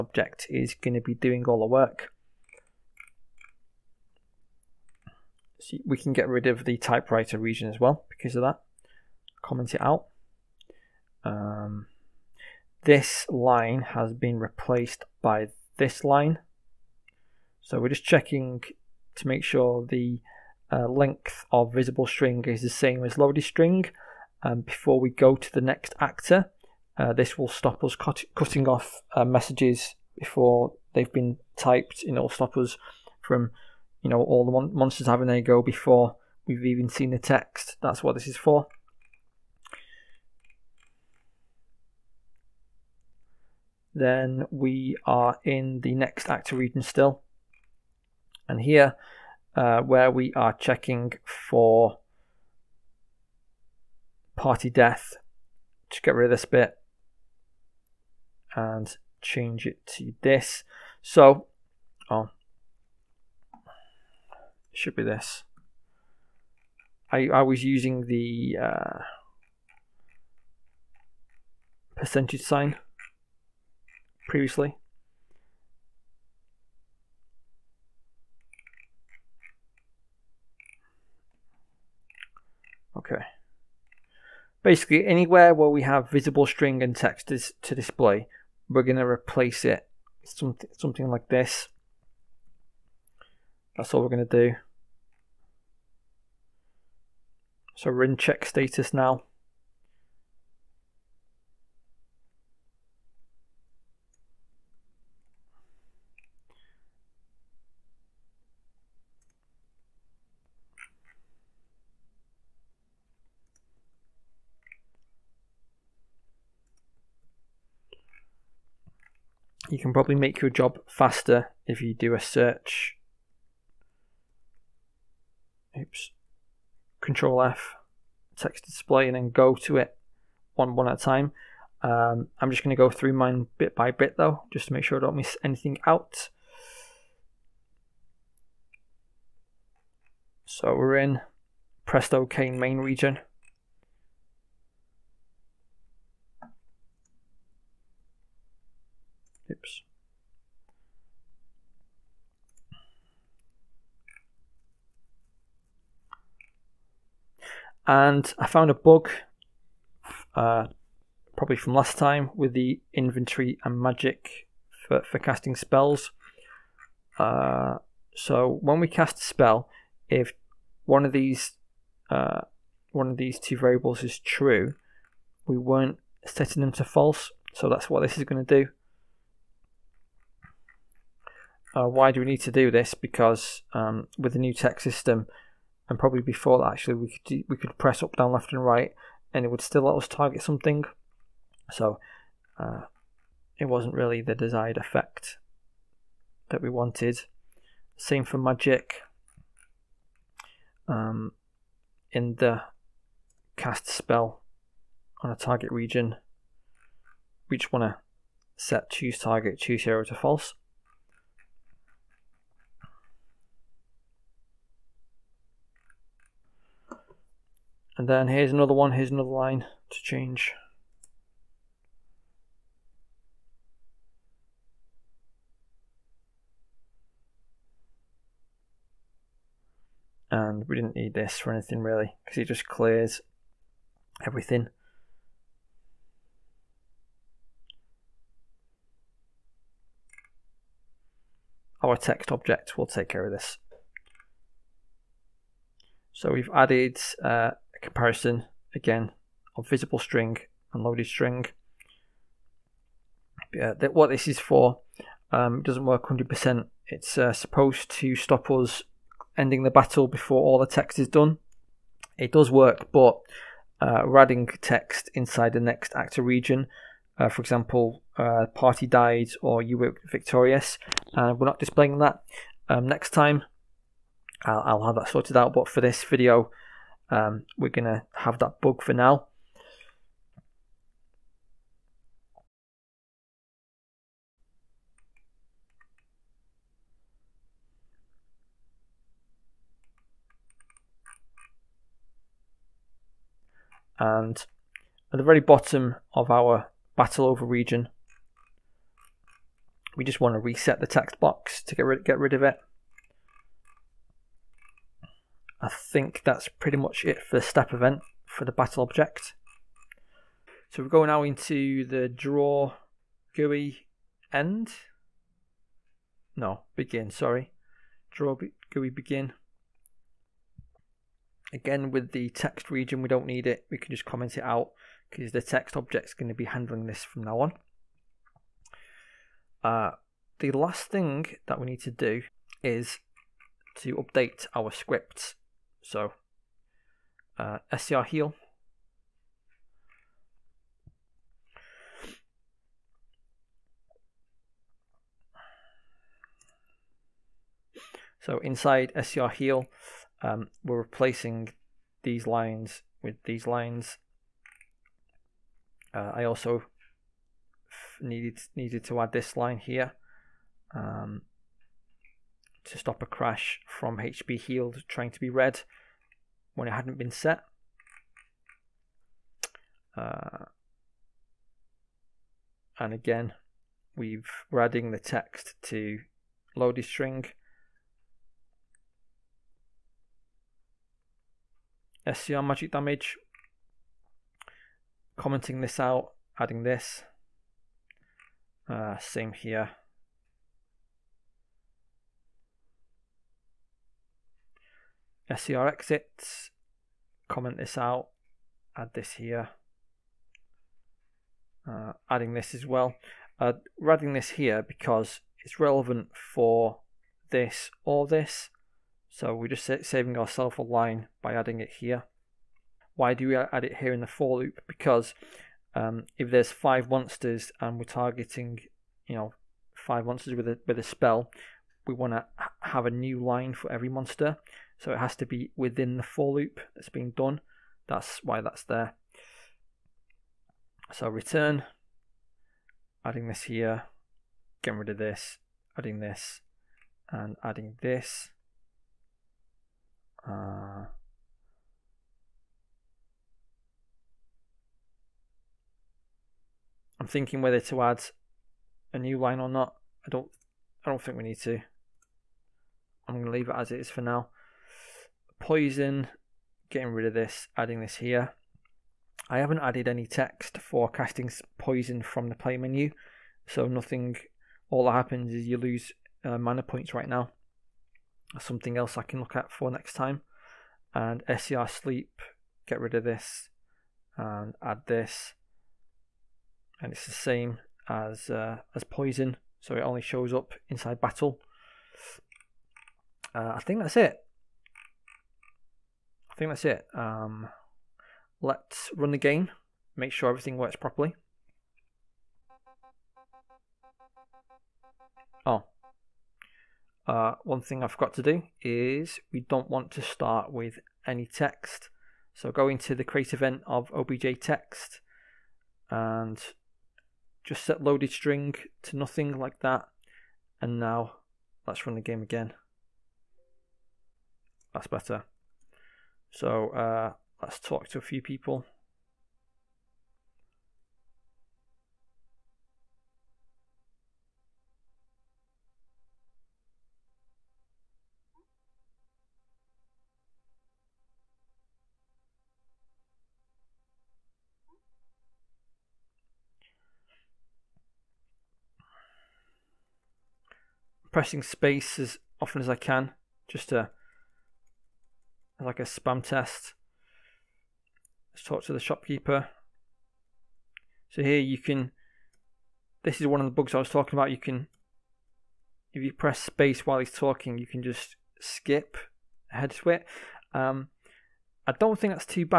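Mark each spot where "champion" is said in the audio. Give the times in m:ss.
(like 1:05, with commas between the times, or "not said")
not said.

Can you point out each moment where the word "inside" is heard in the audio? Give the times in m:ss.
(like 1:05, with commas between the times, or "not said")
4:25, 5:48, 8:00.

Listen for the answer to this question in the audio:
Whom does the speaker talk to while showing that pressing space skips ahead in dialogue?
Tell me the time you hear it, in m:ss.
9:08.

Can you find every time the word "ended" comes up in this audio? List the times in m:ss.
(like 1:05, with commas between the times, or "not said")
not said.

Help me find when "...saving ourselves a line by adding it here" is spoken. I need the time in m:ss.
6:49.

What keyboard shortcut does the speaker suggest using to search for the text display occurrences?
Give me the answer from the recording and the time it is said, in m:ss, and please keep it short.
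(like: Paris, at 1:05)
Control F, at 2:06.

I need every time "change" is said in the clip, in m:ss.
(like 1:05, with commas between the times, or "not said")
0:59, 3:40.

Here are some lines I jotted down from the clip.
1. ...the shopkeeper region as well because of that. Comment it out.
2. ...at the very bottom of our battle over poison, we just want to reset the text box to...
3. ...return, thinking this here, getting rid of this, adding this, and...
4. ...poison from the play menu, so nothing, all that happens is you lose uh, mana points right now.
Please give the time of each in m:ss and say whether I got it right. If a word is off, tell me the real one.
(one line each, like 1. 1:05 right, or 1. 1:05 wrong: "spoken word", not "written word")
1. 0:06 wrong: "typewriter", not "shopkeeper"
2. 4:55 wrong: "region", not "poison"
3. 7:11 wrong: "adding", not "thinking"
4. 7:41 right.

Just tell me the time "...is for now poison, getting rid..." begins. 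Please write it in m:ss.
7:33.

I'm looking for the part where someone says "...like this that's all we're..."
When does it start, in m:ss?
1:31.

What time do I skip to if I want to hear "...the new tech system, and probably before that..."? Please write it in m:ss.
3:04.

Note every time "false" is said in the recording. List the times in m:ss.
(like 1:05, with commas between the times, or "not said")
2:56, 3:30.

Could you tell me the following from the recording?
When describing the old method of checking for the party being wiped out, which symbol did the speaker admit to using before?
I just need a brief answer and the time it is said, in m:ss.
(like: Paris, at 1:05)
percentage sign, at 1:11.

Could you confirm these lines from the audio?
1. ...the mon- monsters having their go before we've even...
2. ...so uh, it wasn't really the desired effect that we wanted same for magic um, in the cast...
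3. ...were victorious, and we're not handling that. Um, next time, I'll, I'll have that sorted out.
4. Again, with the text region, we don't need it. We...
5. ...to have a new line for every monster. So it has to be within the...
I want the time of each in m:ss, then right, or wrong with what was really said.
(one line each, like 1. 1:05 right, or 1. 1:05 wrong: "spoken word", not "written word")
1. 0:34 right
2. 3:11 right
3. 4:29 wrong: "displaying", not "handling"
4. 5:21 right
5. 7:02 right.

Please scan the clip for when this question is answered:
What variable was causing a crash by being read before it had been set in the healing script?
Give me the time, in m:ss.
6:03.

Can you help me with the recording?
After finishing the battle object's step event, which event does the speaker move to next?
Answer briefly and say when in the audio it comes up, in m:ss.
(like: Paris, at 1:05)
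Draw GUI begin, at 5:18.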